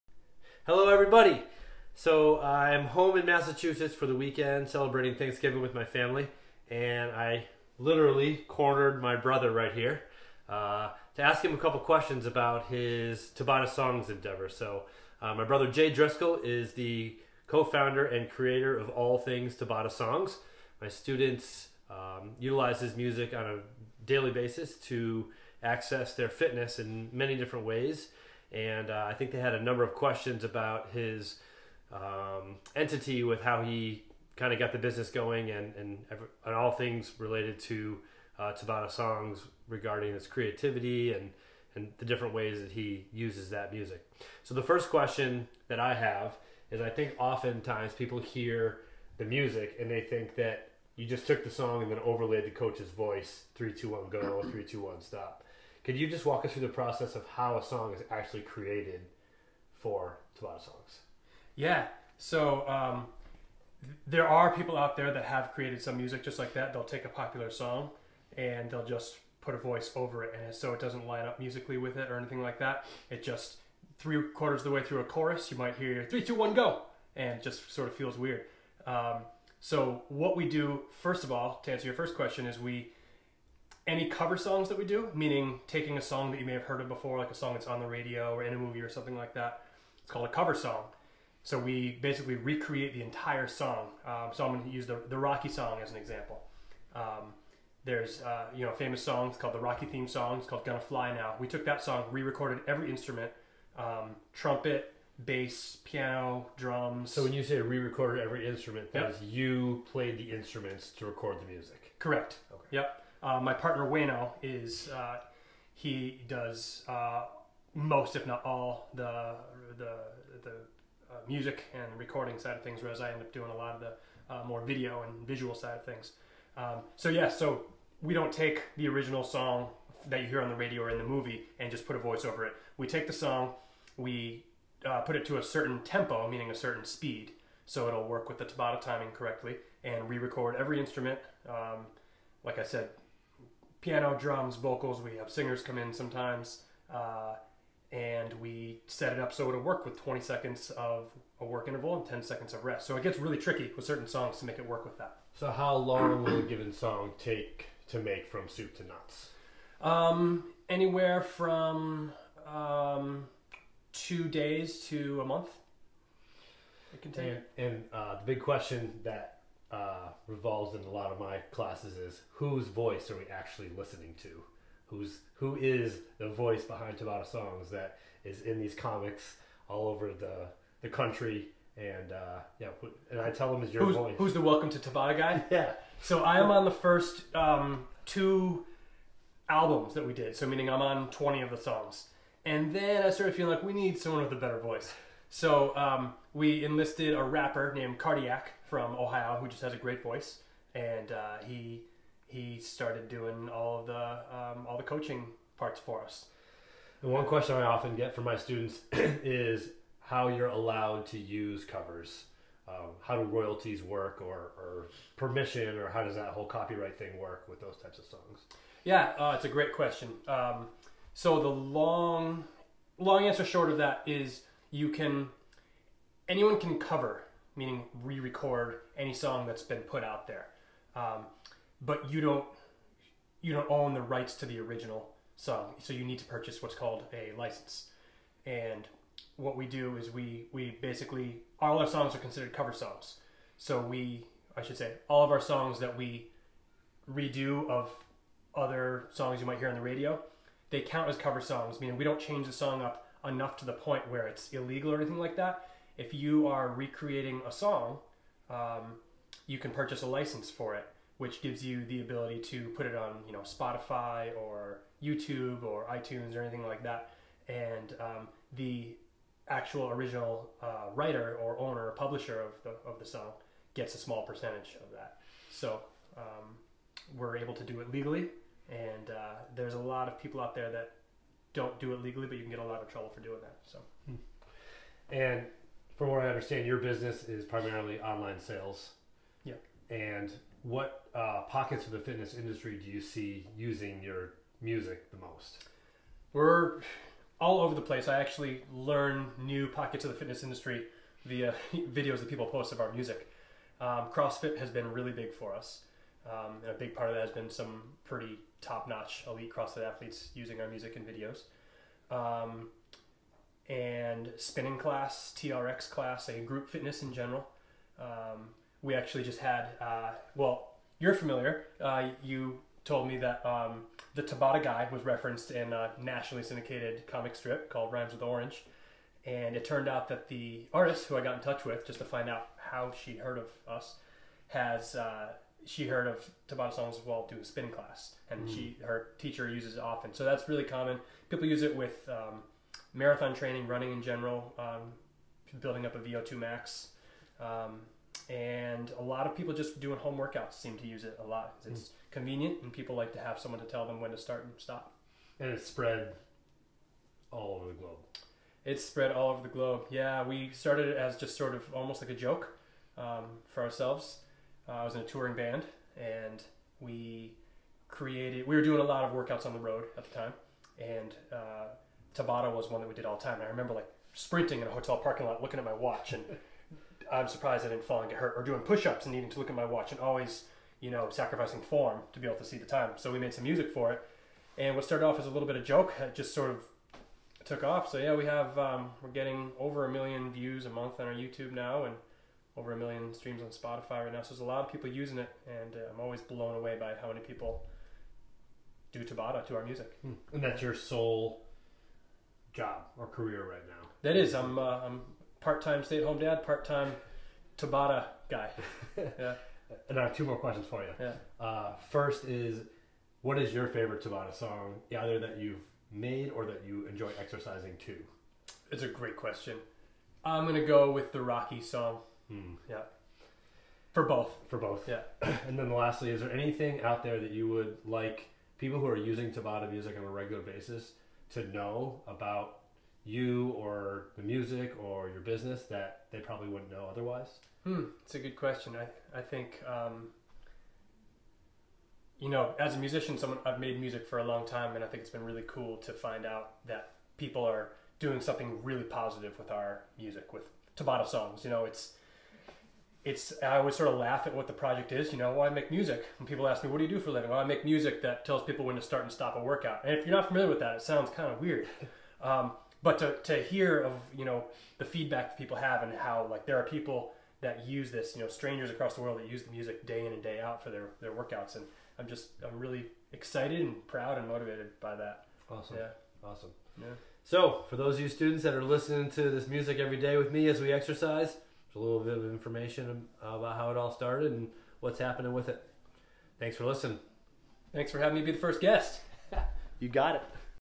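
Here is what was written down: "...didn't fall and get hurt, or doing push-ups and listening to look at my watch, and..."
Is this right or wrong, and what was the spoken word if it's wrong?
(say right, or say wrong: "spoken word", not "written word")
wrong: "needing", not "listening".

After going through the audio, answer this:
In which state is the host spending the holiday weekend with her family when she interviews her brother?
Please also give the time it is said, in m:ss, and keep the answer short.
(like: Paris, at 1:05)
Massachusetts, at 0:03.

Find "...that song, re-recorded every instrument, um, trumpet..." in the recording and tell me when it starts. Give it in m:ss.
1:41.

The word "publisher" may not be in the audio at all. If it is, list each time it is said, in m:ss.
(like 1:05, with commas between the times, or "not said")
4:31.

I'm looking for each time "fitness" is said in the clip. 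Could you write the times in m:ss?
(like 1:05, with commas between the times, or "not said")
0:26, 4:51, 5:00, 5:16.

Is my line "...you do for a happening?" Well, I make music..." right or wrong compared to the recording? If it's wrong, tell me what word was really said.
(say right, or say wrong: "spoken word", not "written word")
wrong: "living", not "happening".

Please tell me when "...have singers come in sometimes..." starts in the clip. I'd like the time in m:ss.
2:25.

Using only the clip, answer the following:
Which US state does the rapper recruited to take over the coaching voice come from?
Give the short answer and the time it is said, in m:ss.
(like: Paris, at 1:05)
Ohio, at 3:18.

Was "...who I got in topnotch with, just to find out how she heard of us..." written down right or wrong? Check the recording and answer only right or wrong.
wrong.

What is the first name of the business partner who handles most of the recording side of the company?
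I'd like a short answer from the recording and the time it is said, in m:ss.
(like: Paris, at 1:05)
Wano, at 1:53.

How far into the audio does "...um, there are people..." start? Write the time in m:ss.
1:02.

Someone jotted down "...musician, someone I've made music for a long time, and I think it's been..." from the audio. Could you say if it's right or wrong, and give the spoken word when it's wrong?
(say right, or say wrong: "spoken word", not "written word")
right.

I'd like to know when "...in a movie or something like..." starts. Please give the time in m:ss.
1:28.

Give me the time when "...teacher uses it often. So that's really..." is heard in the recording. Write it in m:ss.
5:39.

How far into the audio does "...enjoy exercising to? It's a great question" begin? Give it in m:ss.
6:56.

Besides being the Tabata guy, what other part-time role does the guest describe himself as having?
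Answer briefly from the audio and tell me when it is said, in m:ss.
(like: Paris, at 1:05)
Stay at home dad, at 6:45.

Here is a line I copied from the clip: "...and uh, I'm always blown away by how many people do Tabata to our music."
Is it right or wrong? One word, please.
right.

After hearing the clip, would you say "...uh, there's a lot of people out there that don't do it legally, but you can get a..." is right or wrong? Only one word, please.
right.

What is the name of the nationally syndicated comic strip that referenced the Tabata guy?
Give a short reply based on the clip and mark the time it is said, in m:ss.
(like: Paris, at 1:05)
Rhymes with Orange, at 5:27.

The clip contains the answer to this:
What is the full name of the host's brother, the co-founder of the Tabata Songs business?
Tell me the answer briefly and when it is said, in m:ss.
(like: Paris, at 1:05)
Jay Driscoll, at 0:15.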